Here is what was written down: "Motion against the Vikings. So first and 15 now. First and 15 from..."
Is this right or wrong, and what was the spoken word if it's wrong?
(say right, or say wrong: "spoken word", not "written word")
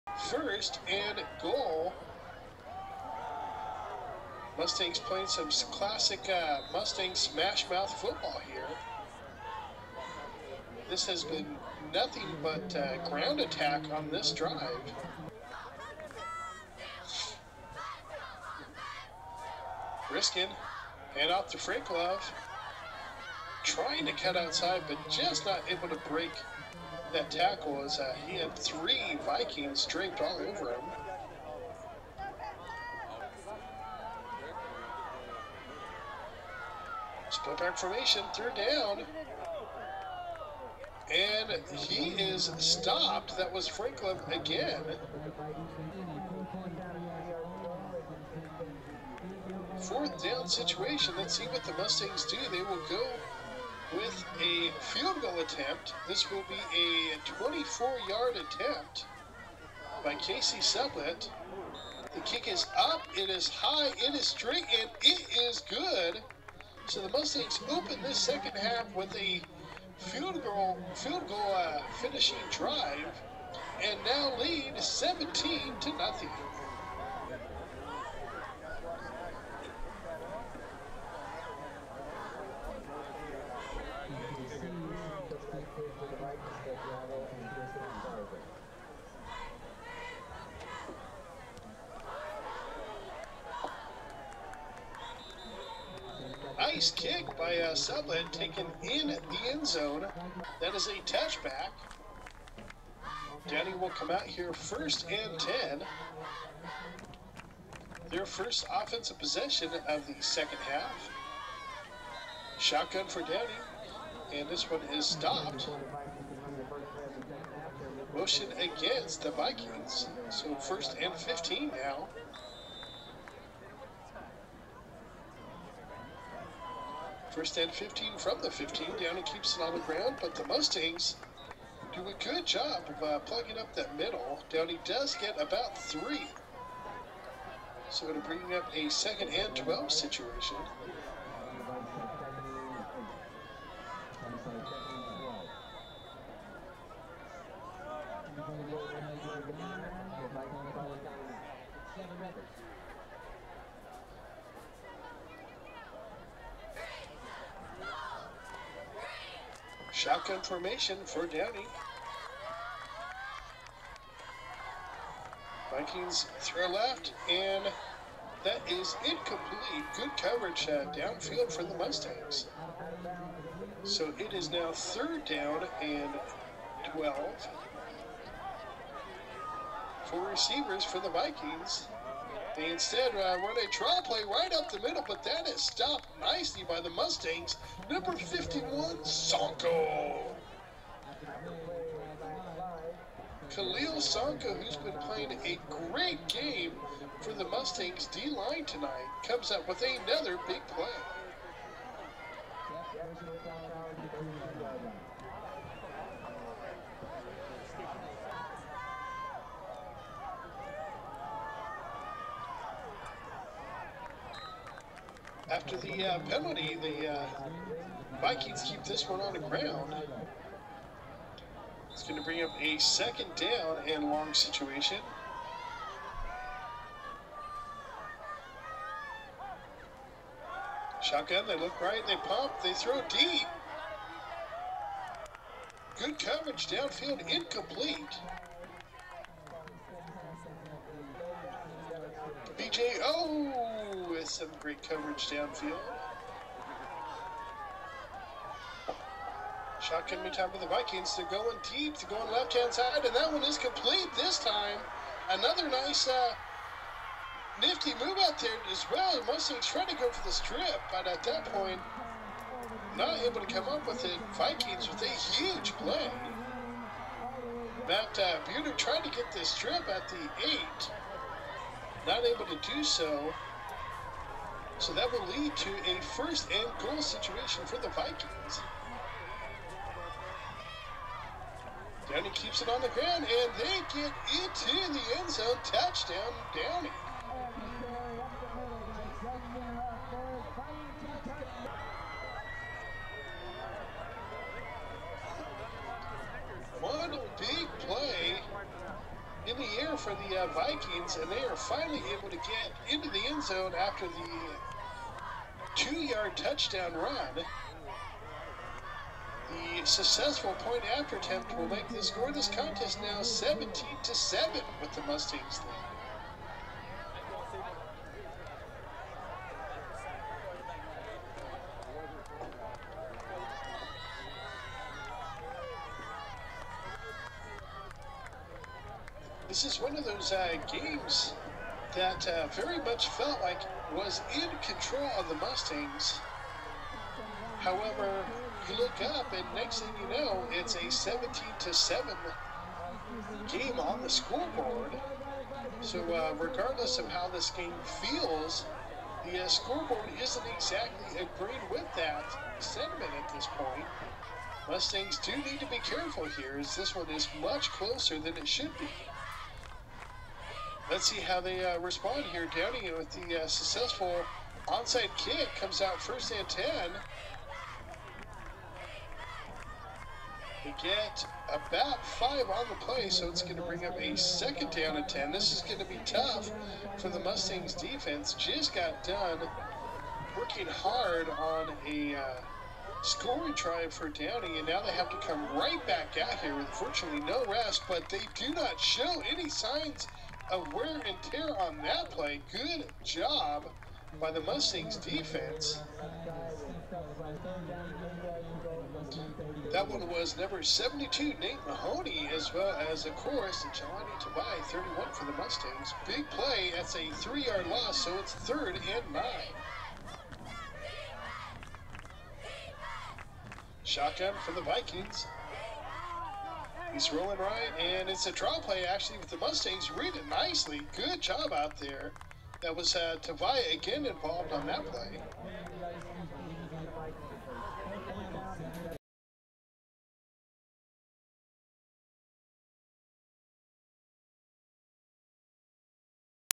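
right.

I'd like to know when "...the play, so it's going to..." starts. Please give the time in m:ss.
6:12.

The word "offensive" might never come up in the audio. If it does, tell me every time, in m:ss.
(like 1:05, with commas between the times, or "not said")
1:48.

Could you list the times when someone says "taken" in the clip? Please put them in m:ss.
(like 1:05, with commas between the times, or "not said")
1:38.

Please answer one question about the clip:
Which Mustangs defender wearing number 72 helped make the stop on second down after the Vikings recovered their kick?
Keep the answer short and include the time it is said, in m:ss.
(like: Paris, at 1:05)
Nate Mahoney, at 6:41.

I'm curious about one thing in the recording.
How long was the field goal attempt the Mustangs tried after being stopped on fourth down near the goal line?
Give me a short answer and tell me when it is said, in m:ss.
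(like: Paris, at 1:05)
24-yard, at 0:57.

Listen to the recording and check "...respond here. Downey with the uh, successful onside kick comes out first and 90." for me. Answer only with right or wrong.
wrong.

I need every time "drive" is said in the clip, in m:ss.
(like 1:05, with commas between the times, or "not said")
0:14, 1:12.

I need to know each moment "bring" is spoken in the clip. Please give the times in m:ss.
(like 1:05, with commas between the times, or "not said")
2:18, 3:42, 6:13.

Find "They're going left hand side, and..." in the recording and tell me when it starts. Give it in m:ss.
4:11.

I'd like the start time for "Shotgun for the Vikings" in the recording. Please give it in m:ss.
6:53.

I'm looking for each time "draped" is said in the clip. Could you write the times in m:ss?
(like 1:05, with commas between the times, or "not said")
0:29.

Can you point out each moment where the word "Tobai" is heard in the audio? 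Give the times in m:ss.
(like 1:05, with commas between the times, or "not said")
6:44.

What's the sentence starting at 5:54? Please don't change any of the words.
Mustangs do need to be careful here, as this one is much closer than it should be.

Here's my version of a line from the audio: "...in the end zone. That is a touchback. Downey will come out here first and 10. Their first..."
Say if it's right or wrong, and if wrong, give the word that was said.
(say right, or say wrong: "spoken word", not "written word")
right.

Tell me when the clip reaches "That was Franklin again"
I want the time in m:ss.
0:43.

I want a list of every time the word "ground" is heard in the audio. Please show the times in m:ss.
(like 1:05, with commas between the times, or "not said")
0:13, 2:09, 3:39, 4:42.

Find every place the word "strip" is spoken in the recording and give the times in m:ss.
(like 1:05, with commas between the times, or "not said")
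4:20, 4:29.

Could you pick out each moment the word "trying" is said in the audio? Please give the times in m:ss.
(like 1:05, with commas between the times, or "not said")
0:23, 4:19.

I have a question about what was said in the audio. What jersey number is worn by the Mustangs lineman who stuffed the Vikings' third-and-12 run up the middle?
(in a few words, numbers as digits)
51.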